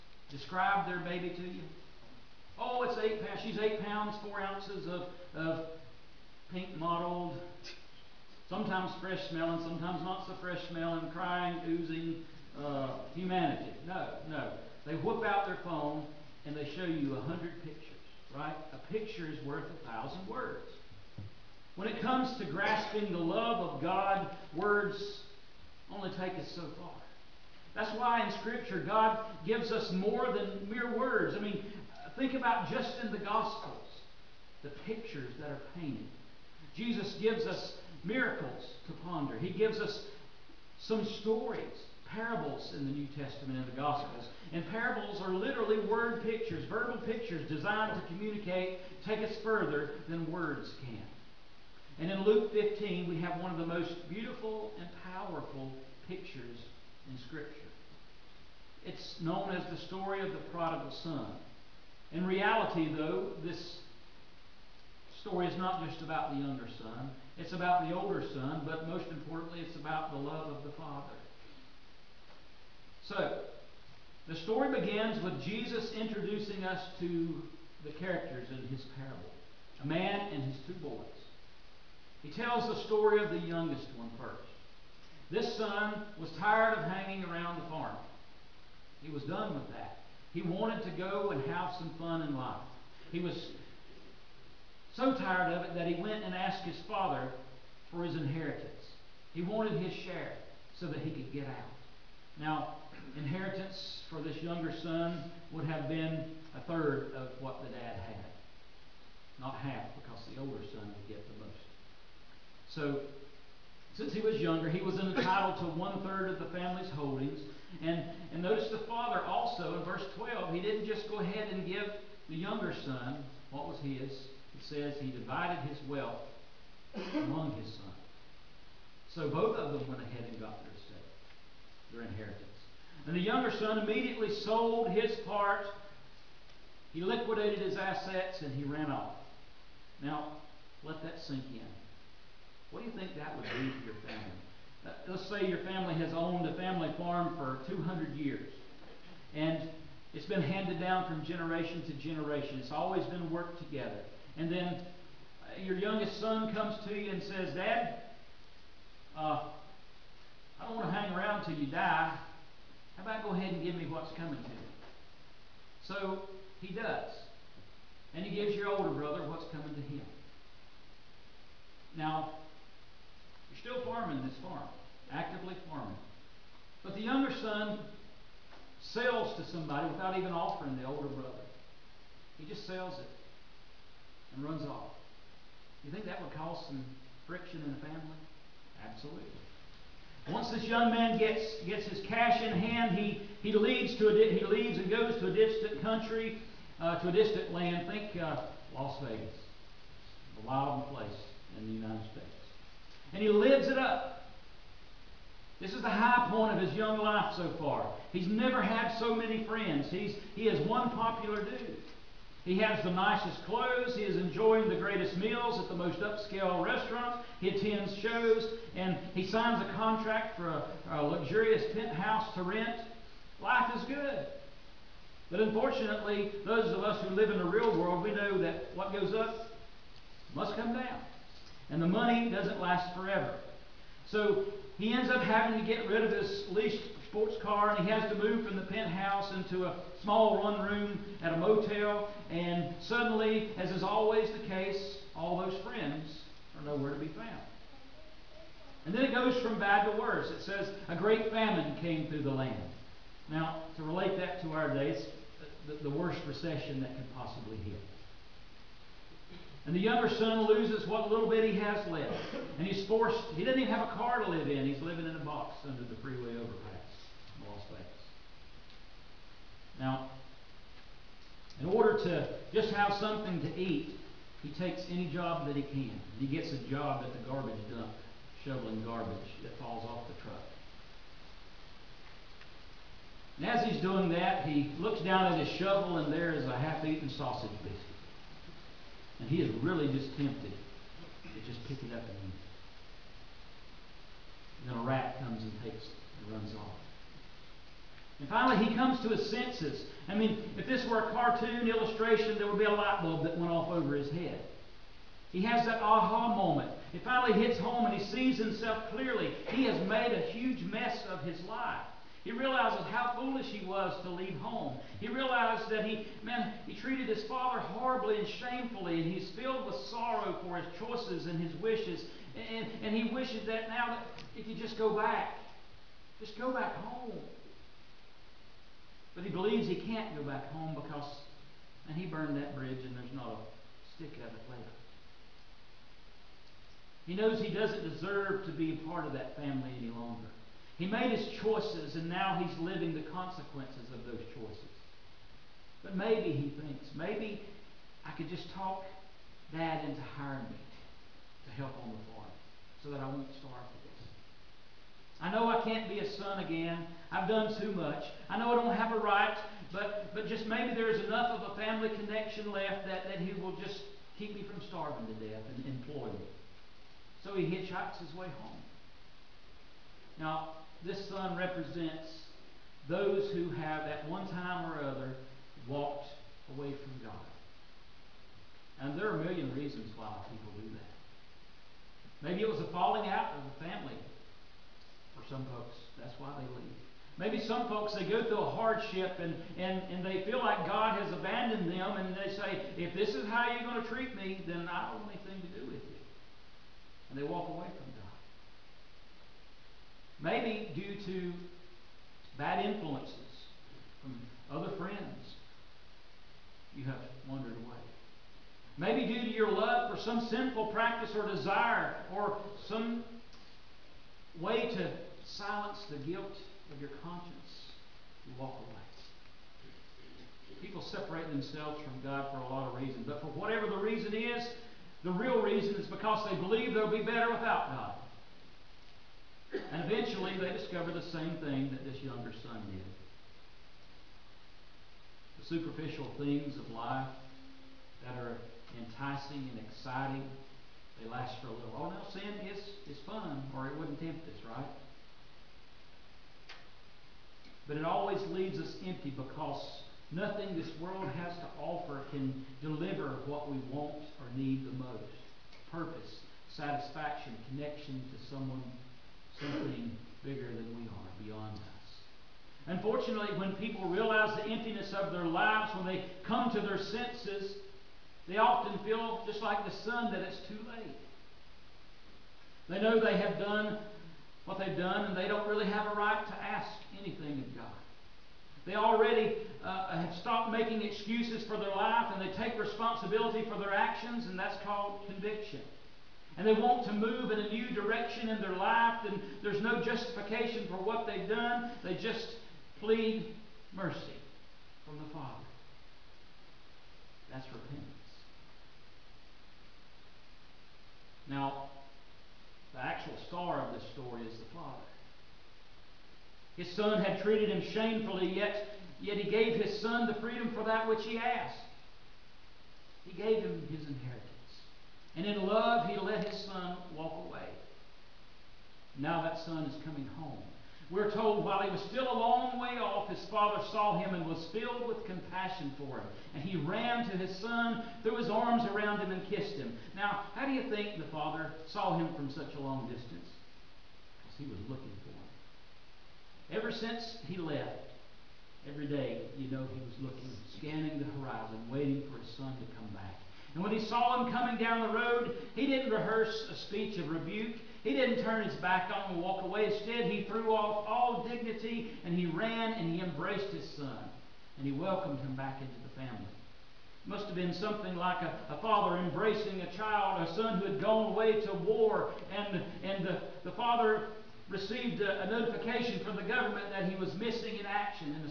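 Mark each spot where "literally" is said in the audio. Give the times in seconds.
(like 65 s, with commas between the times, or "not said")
45 s.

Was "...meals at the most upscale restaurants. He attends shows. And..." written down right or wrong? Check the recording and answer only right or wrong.
right.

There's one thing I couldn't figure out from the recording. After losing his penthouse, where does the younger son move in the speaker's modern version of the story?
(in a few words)
A motel.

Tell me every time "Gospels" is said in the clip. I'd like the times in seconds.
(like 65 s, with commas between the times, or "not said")
33 s, 43 s.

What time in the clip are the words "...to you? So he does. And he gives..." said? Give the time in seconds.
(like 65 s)
164 s.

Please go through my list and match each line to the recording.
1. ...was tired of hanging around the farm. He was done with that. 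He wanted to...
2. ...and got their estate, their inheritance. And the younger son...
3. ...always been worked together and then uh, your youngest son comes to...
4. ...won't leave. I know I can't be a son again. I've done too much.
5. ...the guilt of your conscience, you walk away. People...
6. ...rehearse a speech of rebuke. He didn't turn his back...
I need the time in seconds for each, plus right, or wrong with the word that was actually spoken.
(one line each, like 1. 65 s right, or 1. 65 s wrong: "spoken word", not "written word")
1. 86 s right
2. 130 s right
3. 152 s right
4. 353 s wrong: "starve", not "leave"
5. 415 s right
6. 545 s right.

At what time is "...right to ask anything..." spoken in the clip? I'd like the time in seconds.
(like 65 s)
475 s.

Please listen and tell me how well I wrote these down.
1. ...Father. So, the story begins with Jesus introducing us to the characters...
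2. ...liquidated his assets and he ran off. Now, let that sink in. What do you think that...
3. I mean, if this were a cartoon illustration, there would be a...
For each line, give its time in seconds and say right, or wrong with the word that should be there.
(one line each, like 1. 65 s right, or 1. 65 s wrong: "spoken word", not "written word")
1. 70 s right
2. 137 s right
3. 300 s right.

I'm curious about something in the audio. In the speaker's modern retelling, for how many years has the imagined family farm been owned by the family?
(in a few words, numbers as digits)
200.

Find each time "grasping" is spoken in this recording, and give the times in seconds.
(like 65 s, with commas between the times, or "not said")
22 s.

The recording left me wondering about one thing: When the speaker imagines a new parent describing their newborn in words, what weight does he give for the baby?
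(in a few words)
8 pounds, 4 ounces.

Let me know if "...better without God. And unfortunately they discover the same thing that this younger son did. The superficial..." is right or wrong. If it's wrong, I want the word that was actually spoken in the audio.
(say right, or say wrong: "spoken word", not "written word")
wrong: "eventually", not "unfortunately".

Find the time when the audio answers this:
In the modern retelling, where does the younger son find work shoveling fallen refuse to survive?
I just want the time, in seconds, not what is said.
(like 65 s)
277 s.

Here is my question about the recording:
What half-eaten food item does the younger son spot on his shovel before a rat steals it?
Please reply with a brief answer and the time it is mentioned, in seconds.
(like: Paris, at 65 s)
Sausage biscuit, at 287 s.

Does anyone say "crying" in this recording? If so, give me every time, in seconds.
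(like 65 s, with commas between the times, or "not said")
11 s.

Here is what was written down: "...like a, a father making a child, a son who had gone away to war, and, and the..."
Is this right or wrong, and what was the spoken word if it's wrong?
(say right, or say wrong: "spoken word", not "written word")
wrong: "embracing", not "making".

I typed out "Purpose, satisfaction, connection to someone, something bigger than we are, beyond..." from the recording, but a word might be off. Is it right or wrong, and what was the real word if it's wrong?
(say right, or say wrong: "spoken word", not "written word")
right.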